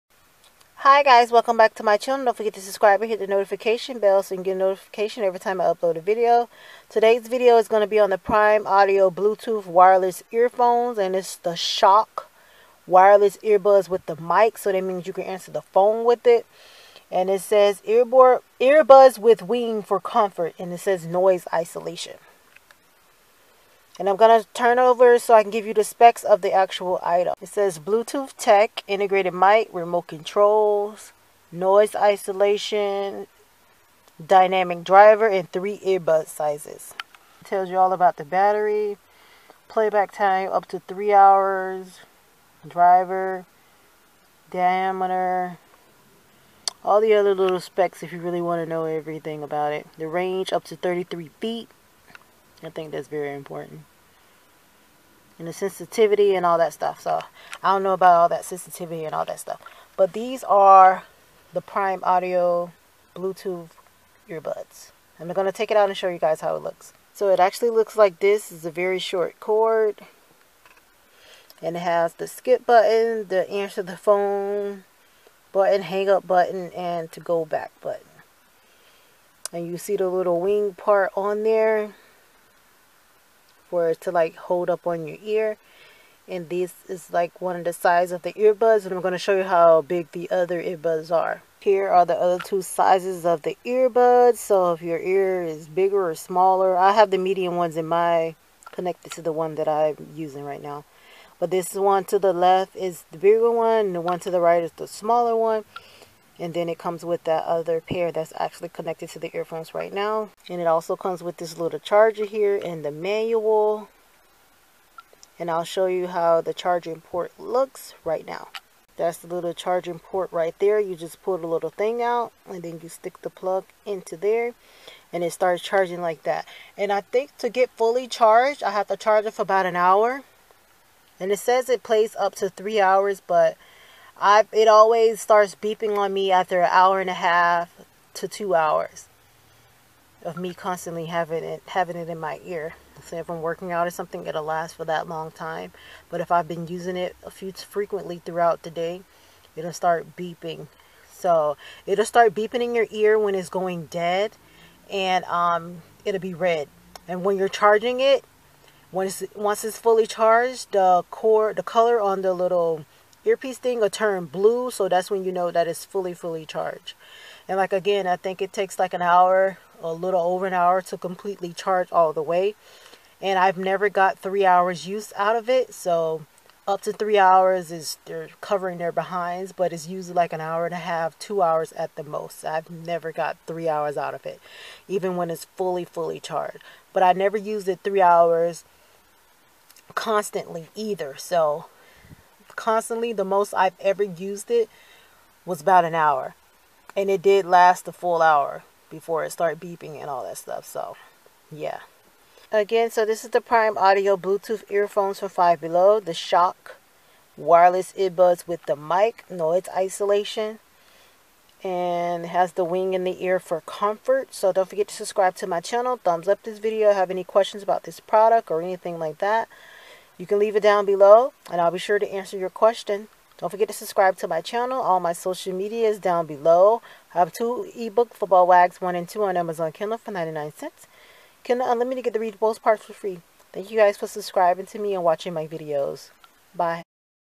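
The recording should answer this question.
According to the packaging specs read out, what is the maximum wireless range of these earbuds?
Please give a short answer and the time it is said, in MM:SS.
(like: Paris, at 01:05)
33 feet, at 00:50.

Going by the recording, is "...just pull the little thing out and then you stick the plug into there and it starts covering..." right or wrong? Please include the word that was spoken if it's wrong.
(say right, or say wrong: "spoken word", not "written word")
wrong: "charging", not "covering".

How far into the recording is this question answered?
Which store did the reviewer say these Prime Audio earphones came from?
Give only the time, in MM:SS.
03:25.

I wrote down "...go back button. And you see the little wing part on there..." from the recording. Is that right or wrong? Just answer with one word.
right.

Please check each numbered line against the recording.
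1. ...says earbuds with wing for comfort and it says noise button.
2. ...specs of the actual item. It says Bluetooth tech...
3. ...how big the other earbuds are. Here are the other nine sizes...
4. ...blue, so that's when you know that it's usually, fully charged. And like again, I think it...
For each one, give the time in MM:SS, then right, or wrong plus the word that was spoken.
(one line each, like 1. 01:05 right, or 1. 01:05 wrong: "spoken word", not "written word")
1. 00:17 wrong: "isolation", not "button"
2. 00:25 right
3. 01:29 wrong: "two", not "nine"
4. 02:44 wrong: "fully", not "usually".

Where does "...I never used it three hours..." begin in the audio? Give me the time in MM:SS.
03:07.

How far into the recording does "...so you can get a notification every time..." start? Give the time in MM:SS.
00:04.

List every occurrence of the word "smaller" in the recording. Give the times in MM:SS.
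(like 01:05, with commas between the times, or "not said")
01:36, 01:44.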